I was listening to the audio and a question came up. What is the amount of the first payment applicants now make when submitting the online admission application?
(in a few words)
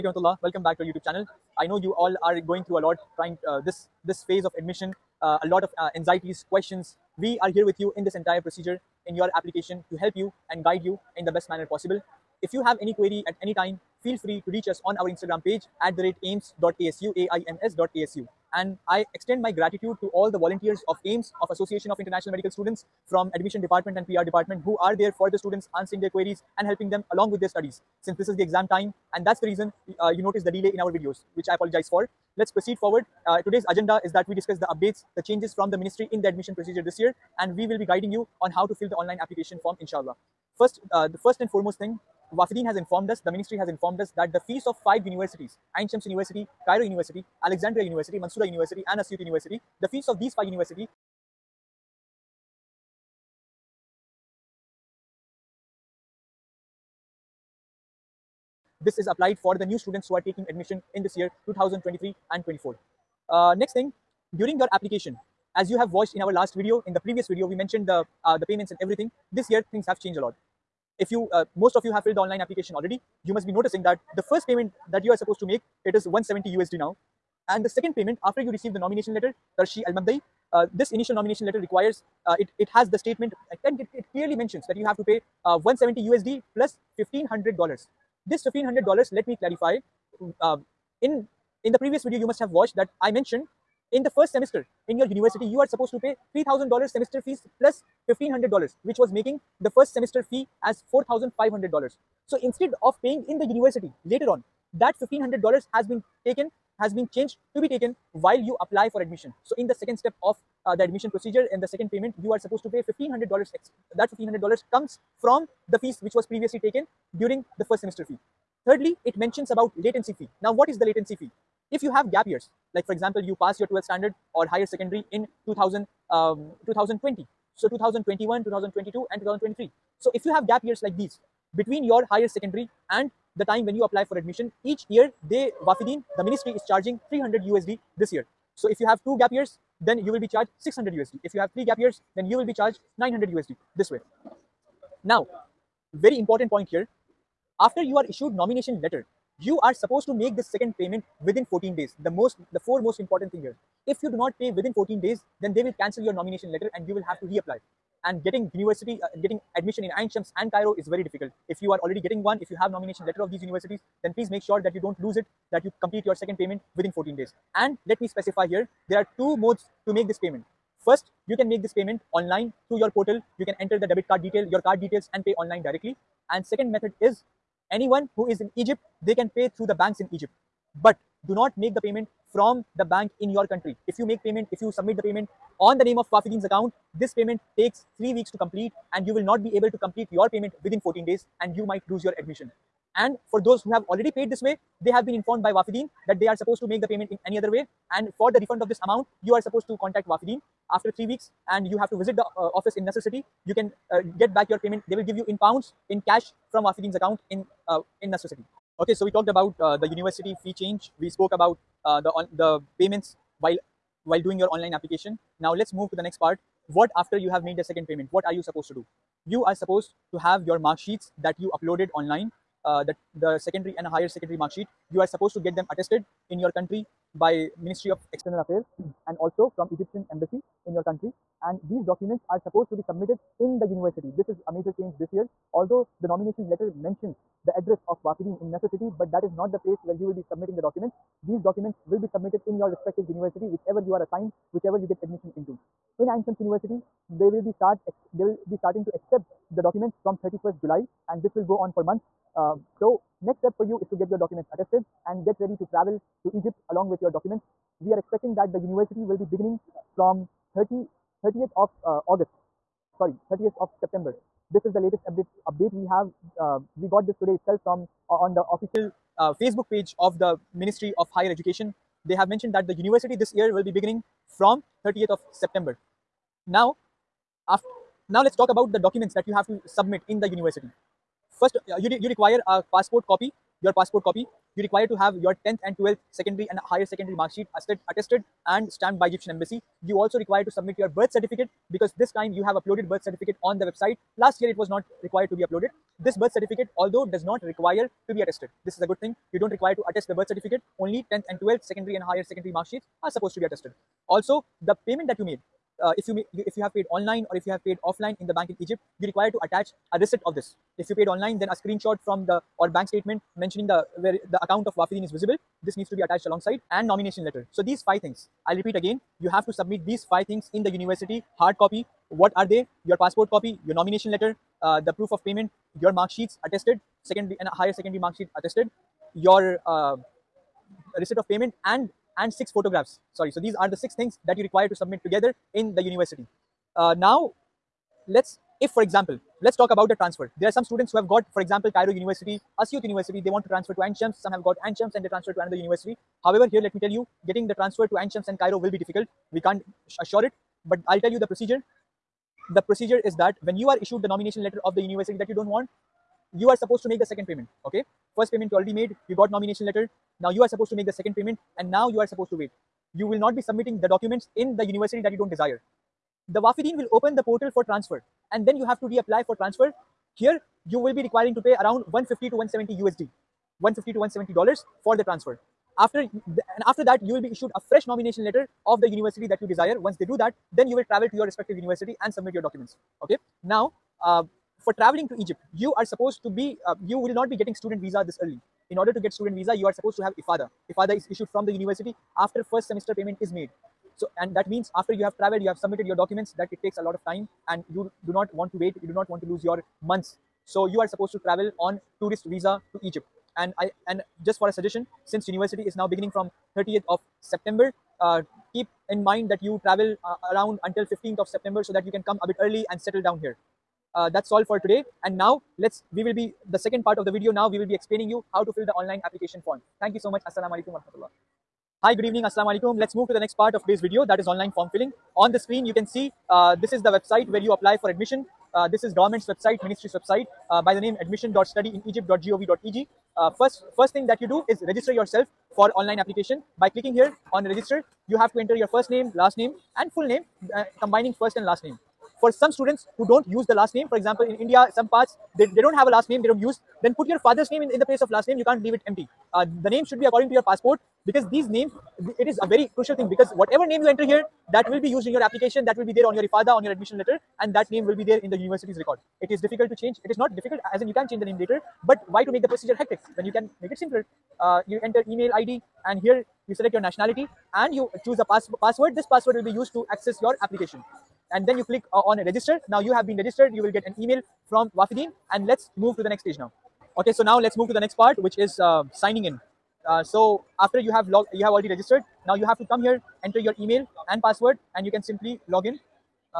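170 USD.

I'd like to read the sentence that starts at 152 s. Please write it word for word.
The most, the four most important thing here.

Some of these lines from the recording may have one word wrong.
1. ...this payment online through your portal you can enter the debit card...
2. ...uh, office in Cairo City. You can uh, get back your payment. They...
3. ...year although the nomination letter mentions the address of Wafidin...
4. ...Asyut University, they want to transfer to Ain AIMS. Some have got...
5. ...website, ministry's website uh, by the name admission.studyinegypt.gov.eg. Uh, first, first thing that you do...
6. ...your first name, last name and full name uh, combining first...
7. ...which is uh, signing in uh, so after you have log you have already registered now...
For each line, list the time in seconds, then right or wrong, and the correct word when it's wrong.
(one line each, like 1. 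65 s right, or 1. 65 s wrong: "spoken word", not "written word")
1. 171 s right
2. 202 s wrong: "Nasser", not "Cairo"
3. 235 s right
4. 342 s wrong: "Shams", not "AIMS"
5. 429 s right
6. 438 s right
7. 478 s right.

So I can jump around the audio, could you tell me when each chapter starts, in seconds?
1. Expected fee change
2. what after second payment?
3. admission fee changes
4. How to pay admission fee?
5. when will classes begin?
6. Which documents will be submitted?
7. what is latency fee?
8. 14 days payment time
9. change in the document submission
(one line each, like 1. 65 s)
1. 41 s
2. 216 s
3. 65 s
4. 168 s
5. 258 s
6. 277 s
7. 120 s
8. 146 s
9. 231 s.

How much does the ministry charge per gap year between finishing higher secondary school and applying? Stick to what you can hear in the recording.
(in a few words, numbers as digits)
300 USD.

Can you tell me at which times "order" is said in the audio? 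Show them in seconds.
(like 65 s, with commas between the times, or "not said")
388 s.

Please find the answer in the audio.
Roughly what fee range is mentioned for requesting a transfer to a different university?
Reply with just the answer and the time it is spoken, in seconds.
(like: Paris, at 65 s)
150 to 170 USD, at 371 s.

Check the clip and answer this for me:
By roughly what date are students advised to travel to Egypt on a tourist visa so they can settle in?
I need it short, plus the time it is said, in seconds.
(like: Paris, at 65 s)
15 September, at 410 s.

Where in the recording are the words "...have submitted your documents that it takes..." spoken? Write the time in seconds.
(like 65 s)
395 s.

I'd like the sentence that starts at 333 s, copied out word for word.
Sorry, so these are the six things that you require to submit together in the university.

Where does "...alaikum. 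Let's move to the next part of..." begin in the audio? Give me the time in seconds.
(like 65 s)
422 s.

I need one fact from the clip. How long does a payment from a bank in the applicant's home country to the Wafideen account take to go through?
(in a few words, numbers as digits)
3 weeks.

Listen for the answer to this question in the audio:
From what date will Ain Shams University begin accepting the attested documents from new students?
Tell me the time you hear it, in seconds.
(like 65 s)
250 s.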